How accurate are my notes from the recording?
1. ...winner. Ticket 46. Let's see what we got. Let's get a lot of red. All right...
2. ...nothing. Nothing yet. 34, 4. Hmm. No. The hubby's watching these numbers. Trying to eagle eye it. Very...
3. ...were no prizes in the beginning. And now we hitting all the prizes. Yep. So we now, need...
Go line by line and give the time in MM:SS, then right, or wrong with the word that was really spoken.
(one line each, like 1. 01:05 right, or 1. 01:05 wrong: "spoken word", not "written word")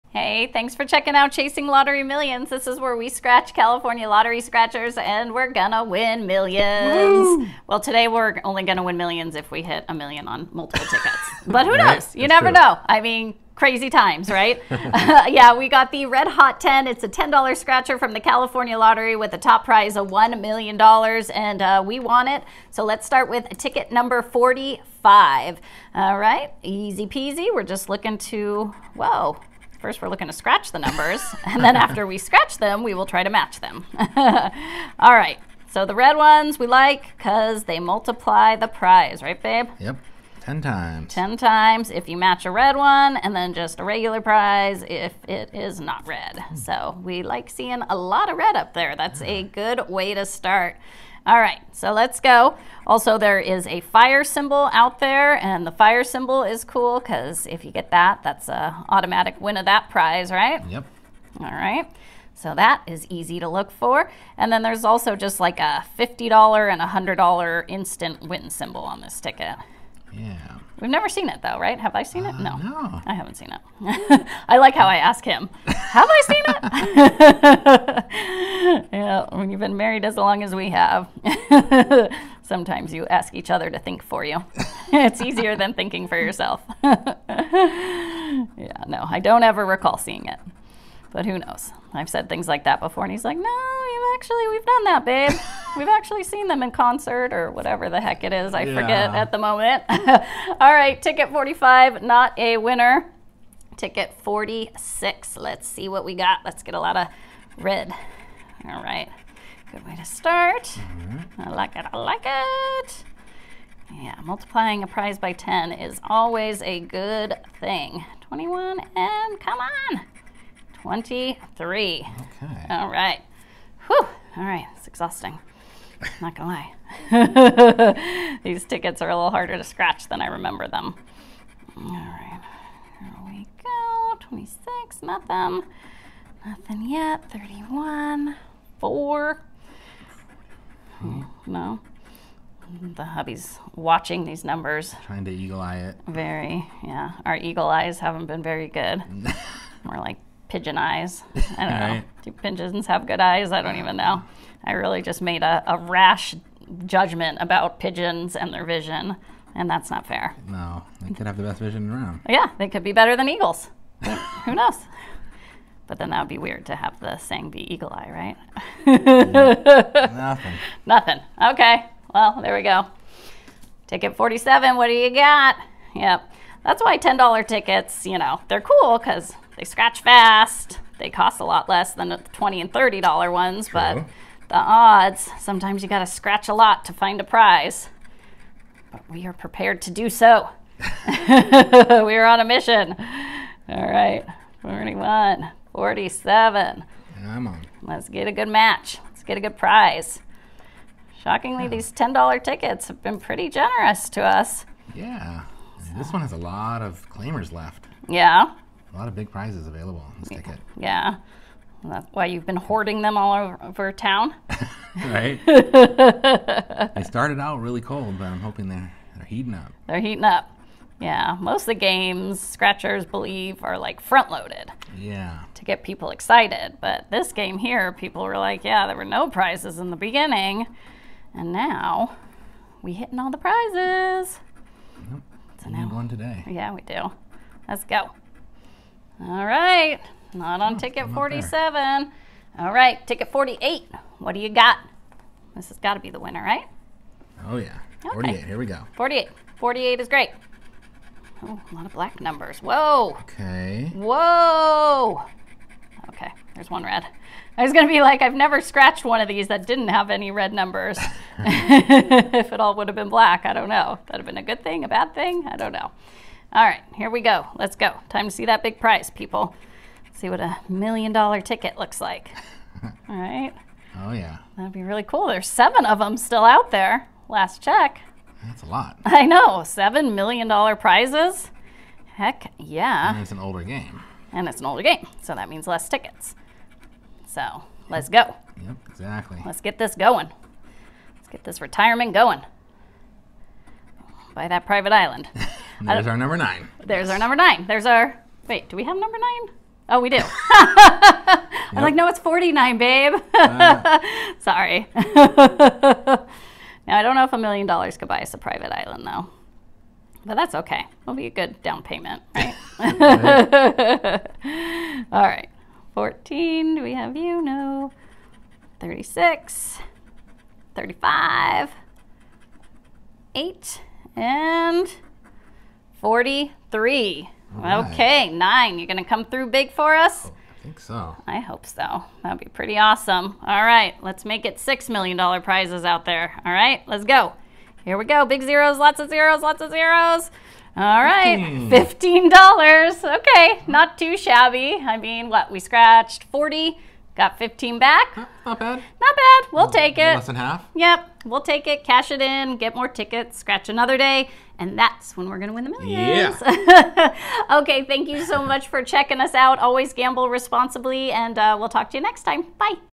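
1. 01:42 right
2. 02:15 wrong: "31", not "34"
3. 03:48 right.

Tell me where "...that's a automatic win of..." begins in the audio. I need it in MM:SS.
00:58.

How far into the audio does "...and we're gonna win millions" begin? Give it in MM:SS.
00:04.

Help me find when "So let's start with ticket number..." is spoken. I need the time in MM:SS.
00:22.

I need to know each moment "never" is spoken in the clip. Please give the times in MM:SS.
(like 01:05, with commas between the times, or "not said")
00:12, 01:10, 04:18.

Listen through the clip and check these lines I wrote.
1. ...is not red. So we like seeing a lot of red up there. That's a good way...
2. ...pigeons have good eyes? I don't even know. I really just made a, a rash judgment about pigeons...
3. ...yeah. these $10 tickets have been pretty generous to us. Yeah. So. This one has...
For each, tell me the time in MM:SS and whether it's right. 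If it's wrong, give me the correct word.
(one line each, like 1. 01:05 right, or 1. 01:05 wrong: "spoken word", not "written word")
1. 00:45 right
2. 02:32 right
3. 03:21 right.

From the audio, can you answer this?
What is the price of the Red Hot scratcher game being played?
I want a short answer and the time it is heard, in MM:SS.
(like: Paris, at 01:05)
$10, at 00:16.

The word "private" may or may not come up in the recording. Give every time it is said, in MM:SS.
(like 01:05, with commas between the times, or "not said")
04:54, 05:08.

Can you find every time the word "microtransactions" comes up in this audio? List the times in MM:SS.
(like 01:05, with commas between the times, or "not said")
not said.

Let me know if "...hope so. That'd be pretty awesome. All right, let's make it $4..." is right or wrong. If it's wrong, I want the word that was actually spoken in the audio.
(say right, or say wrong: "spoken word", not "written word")
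wrong: "6", not "4".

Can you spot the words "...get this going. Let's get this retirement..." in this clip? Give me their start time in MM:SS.
04:49.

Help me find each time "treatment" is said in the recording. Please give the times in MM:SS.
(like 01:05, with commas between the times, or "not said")
not said.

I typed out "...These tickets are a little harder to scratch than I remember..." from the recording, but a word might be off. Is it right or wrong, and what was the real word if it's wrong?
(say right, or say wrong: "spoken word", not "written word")
right.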